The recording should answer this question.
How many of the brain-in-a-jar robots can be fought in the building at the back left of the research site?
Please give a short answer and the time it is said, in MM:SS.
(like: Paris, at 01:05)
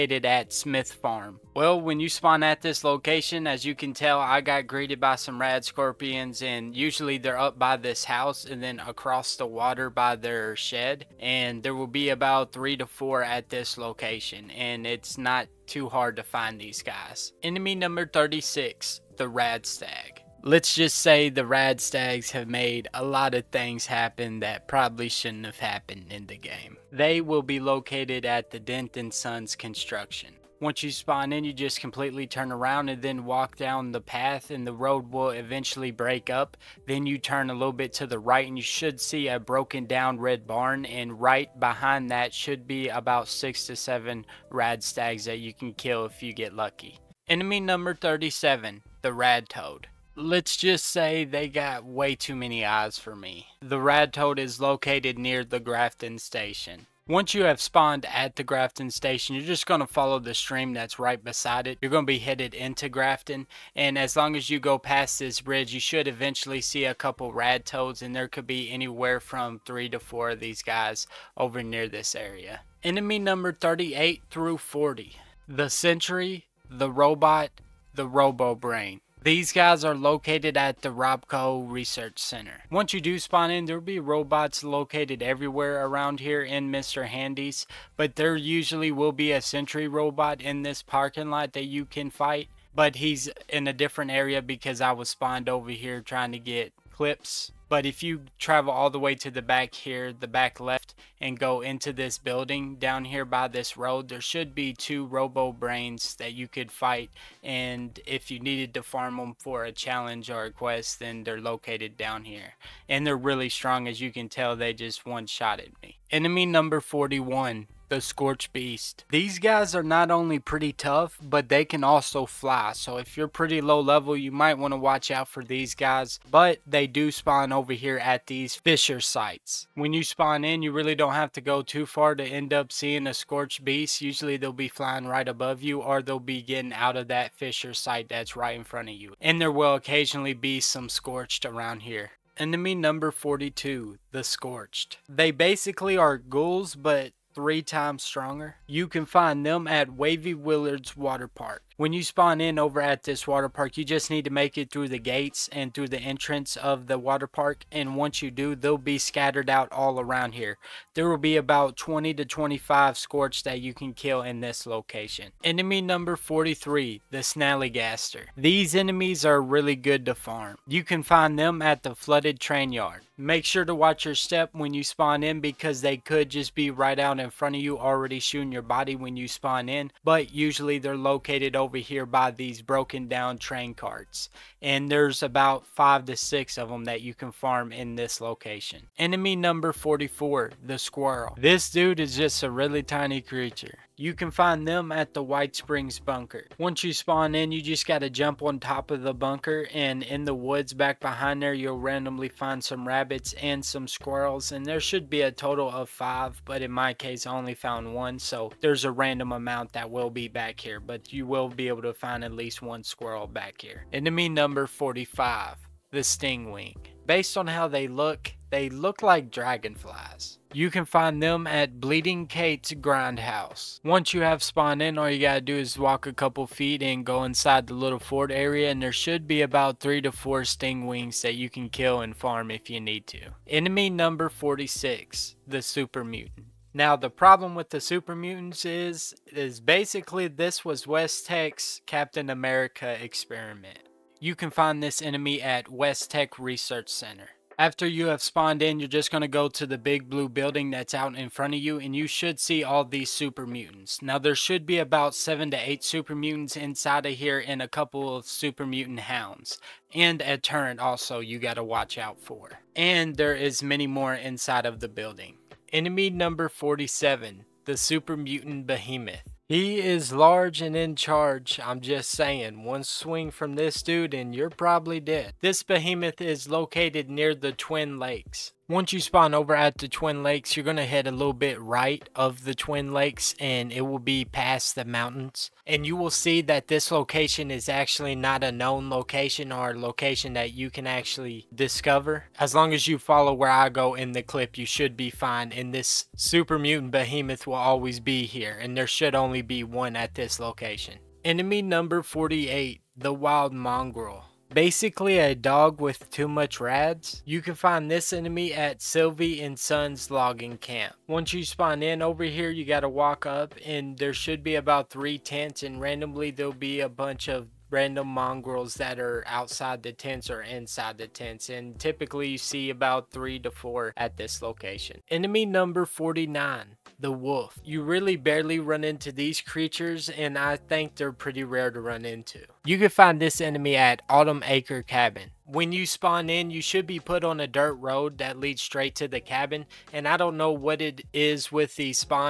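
2, at 01:44.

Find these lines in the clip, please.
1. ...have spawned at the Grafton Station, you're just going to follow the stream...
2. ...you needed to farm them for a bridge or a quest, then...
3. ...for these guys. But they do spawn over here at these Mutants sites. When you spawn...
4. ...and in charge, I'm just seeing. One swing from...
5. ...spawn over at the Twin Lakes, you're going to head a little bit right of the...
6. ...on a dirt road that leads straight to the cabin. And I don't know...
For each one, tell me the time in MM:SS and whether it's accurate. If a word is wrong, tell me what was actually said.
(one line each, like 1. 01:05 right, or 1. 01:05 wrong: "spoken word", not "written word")
1. 00:57 right
2. 01:48 wrong: "challenge", not "bridge"
3. 02:05 wrong: "Fissure", not "Mutants"
4. 04:30 wrong: "saying", not "seeing"
5. 04:38 right
6. 05:37 right.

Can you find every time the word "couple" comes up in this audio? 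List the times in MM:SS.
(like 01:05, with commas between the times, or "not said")
01:06, 03:46, 04:17.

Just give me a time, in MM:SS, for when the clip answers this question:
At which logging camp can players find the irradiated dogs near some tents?
05:08.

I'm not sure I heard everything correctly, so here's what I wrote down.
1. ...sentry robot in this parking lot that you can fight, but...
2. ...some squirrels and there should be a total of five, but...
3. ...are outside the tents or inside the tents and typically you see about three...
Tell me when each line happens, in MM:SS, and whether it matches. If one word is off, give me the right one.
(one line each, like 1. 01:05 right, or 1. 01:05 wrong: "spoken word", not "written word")
1. 01:29 right
2. 03:23 right
3. 05:18 right.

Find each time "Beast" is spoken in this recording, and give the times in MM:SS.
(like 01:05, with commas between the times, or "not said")
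01:58, 02:13.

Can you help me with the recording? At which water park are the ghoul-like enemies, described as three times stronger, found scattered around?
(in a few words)
Wavy Willards Water Park.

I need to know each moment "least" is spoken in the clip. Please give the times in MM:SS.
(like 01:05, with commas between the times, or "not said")
03:32.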